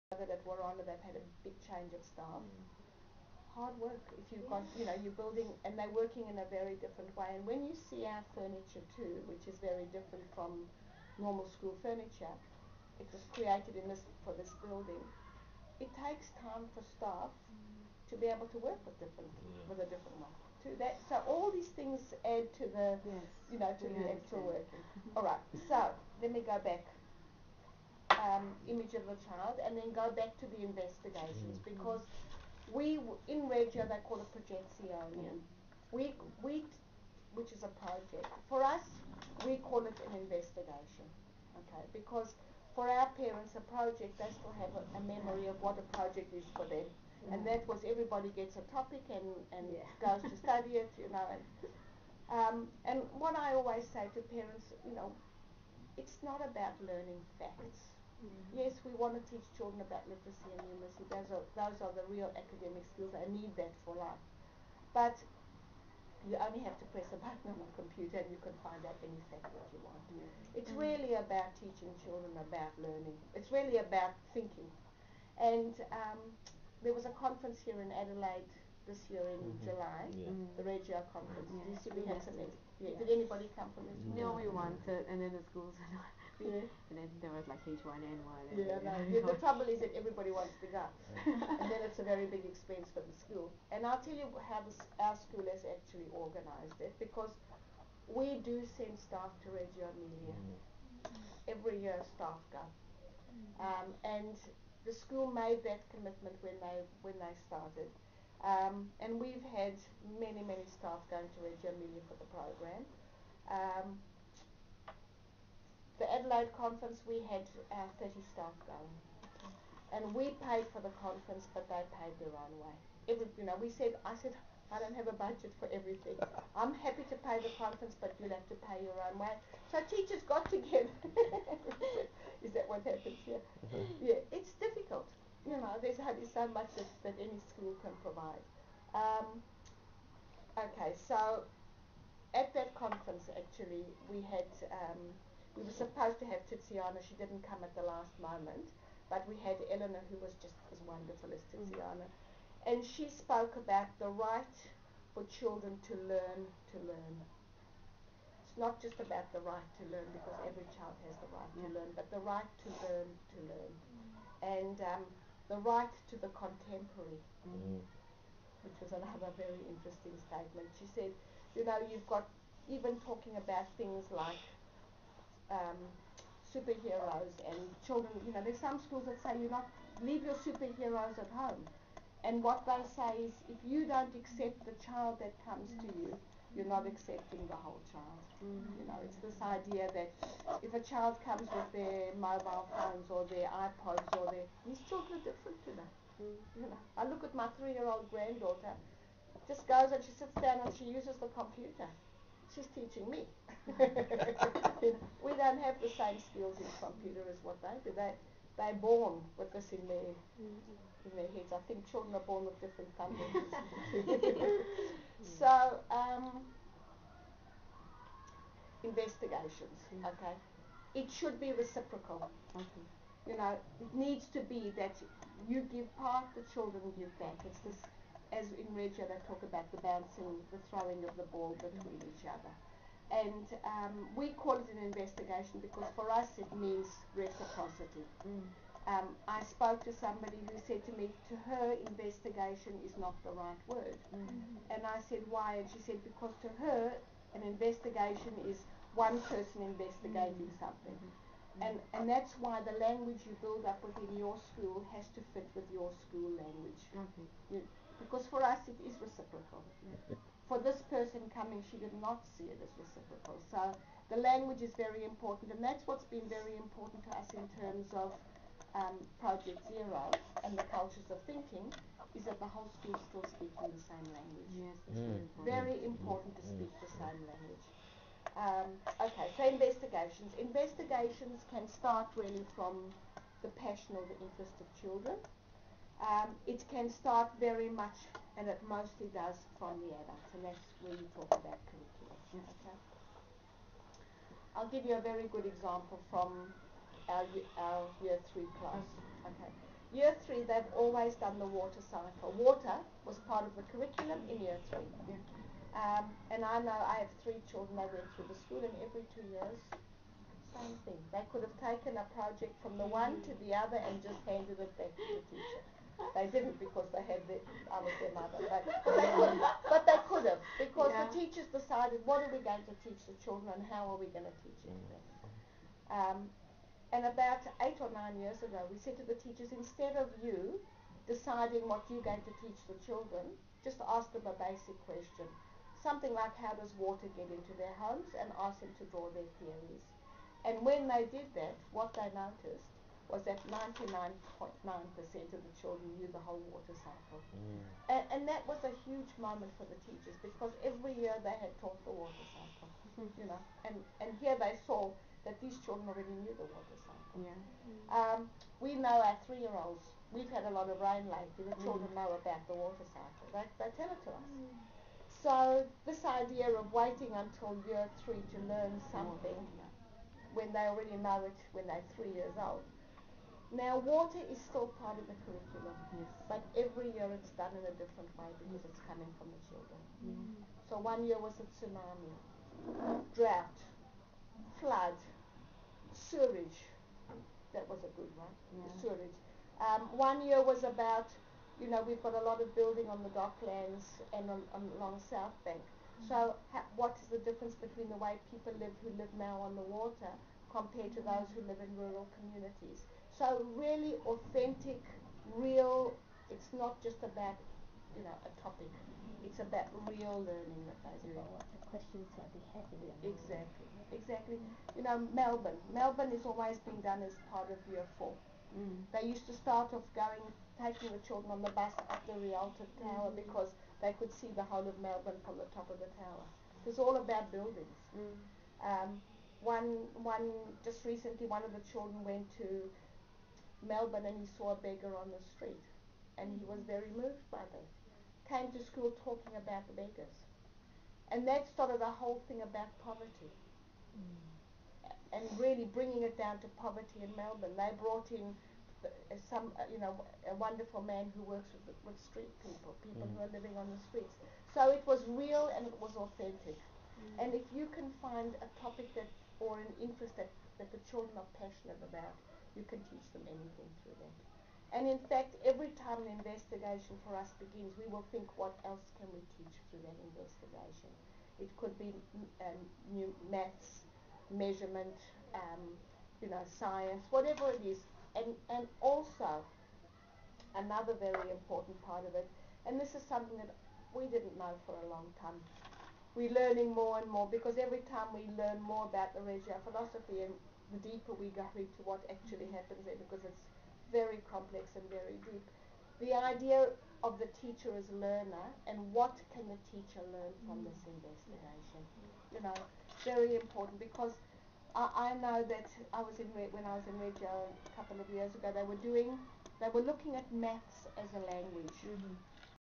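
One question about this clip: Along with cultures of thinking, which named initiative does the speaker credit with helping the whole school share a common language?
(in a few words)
Project Zero.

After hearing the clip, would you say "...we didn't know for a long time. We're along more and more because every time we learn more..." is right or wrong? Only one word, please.
wrong.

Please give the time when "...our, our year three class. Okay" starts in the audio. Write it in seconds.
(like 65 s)
297 s.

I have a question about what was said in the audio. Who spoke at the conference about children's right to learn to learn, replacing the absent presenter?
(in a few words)
Eleanor.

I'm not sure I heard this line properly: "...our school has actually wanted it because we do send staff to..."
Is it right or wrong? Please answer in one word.
wrong.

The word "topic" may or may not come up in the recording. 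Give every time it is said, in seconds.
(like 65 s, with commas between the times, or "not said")
48 s, 408 s, 458 s.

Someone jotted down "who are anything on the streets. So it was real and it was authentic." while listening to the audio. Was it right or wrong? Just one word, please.
wrong.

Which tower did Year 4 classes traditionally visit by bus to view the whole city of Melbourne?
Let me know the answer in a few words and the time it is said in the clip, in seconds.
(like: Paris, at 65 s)
Rialto Tower, at 422 s.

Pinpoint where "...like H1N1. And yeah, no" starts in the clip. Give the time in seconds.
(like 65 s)
87 s.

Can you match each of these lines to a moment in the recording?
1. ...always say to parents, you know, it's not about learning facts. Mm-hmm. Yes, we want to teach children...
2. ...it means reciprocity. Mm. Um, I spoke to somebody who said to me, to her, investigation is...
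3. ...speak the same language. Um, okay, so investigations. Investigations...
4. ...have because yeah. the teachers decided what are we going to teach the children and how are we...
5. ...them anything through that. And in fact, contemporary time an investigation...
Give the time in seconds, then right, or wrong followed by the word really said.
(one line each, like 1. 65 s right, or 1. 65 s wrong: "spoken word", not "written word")
1. 53 s right
2. 236 s right
3. 276 s right
4. 320 s right
5. 463 s wrong: "every", not "contemporary".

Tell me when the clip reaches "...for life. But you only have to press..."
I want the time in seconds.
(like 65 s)
63 s.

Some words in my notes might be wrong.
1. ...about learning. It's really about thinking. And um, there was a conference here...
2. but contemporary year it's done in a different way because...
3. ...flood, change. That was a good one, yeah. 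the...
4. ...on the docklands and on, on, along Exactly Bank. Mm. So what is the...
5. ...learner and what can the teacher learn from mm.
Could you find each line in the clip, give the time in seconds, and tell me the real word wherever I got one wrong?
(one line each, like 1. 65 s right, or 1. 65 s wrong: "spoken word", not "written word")
1. 72 s right
2. 376 s wrong: "every", not "contemporary"
3. 384 s wrong: "sewerage", not "change"
4. 392 s wrong: "South", not "Exactly"
5. 497 s right.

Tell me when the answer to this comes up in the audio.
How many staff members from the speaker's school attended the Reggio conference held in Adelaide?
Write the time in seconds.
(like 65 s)
118 s.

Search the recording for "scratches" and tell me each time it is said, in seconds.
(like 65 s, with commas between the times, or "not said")
not said.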